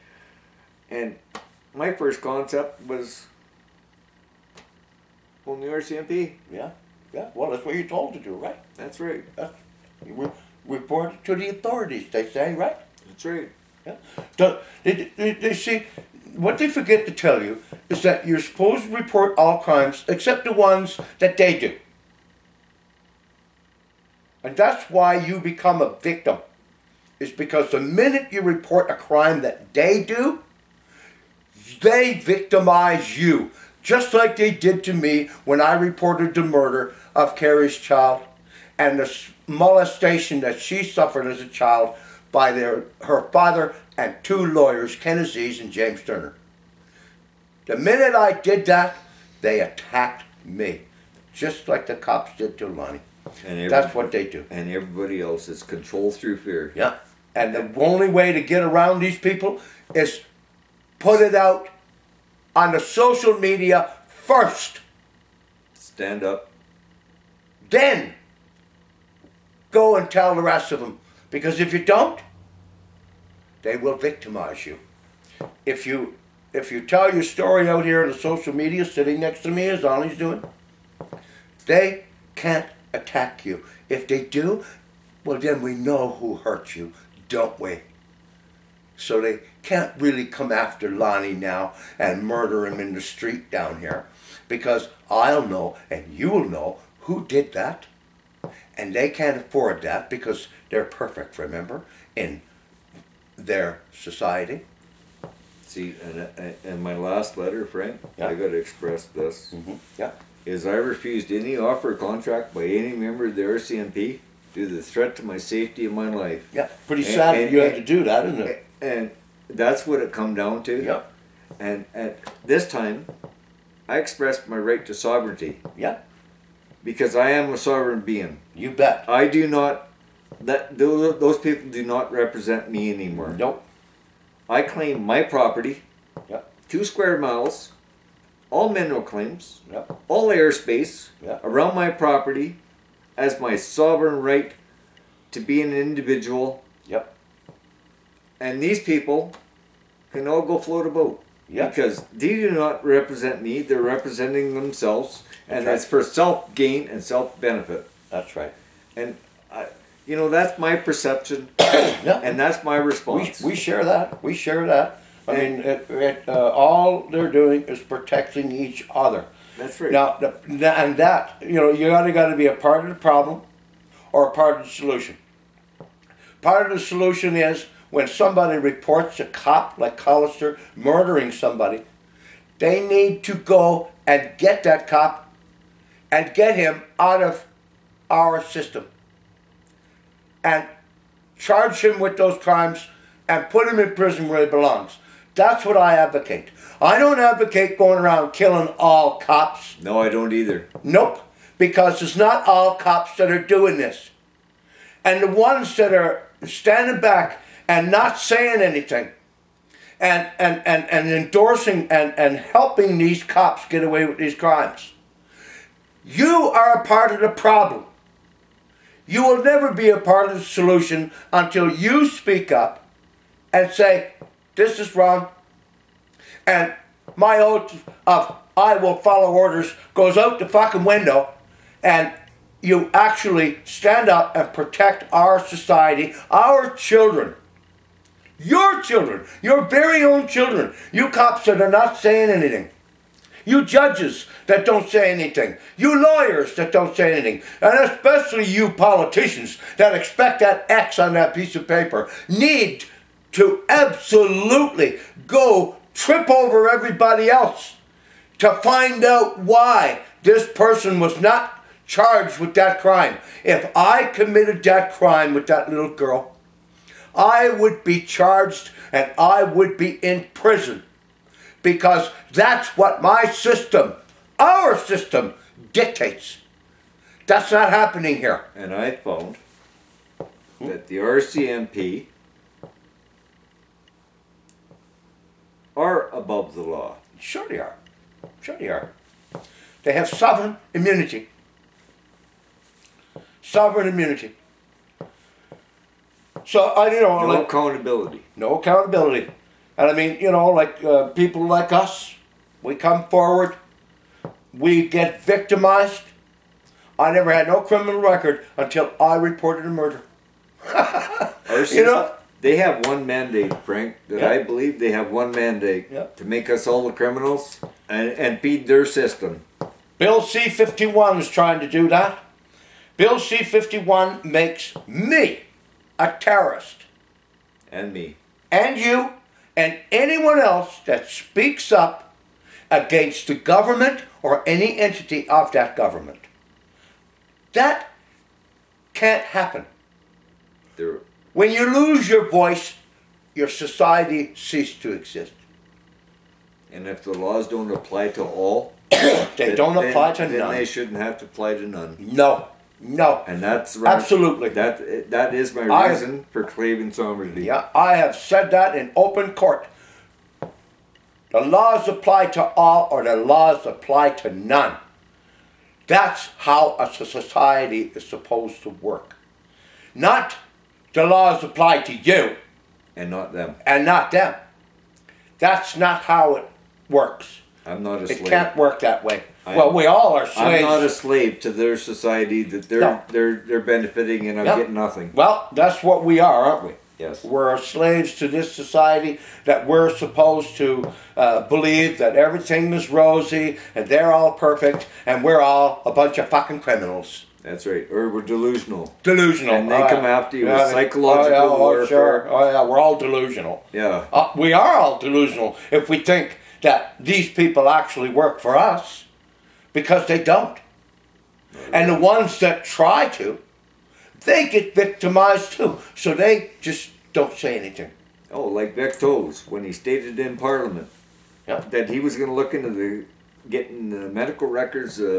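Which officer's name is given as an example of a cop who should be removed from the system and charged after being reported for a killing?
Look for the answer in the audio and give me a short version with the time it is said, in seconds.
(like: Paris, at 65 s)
Collister, at 179 s.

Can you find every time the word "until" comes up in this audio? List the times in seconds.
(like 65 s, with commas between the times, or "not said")
221 s, 308 s.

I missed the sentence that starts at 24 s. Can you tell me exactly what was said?
And that's why you become a victim.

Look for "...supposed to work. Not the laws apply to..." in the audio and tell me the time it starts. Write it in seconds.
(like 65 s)
368 s.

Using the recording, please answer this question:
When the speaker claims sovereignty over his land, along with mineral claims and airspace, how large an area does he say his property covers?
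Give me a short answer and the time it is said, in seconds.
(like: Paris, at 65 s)
2 square miles, at 136 s.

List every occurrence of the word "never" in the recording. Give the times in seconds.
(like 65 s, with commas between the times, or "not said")
219 s, 307 s.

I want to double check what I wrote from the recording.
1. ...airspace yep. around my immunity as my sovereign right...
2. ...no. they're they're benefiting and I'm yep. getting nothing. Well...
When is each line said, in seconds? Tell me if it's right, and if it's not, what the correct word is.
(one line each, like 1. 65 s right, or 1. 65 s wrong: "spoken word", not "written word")
1. 140 s wrong: "property", not "immunity"
2. 382 s right.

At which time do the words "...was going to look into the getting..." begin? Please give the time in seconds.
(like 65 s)
421 s.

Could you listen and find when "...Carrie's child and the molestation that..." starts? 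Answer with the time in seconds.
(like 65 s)
37 s.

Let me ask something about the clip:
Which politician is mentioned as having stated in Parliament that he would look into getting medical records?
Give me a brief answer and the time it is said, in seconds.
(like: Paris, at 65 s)
Vic Toews, at 418 s.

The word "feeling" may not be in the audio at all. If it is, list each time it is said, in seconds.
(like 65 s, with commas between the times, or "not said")
not said.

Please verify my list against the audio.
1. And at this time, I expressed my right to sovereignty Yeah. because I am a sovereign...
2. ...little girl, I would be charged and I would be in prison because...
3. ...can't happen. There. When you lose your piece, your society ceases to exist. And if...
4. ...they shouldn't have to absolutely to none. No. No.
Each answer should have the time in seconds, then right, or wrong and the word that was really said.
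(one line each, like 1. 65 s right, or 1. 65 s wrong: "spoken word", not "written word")
1. 121 s right
2. 265 s right
3. 338 s wrong: "voice", not "piece"
4. 350 s wrong: "apply", not "absolutely".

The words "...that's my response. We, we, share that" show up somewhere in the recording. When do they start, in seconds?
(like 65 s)
162 s.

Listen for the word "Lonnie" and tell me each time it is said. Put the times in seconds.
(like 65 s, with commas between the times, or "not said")
52 s, 79 s, 90 s.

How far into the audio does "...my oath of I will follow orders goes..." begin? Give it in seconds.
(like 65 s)
227 s.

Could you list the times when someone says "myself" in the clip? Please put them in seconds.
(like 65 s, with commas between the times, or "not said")
not said.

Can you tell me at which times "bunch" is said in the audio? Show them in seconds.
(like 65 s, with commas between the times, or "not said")
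395 s.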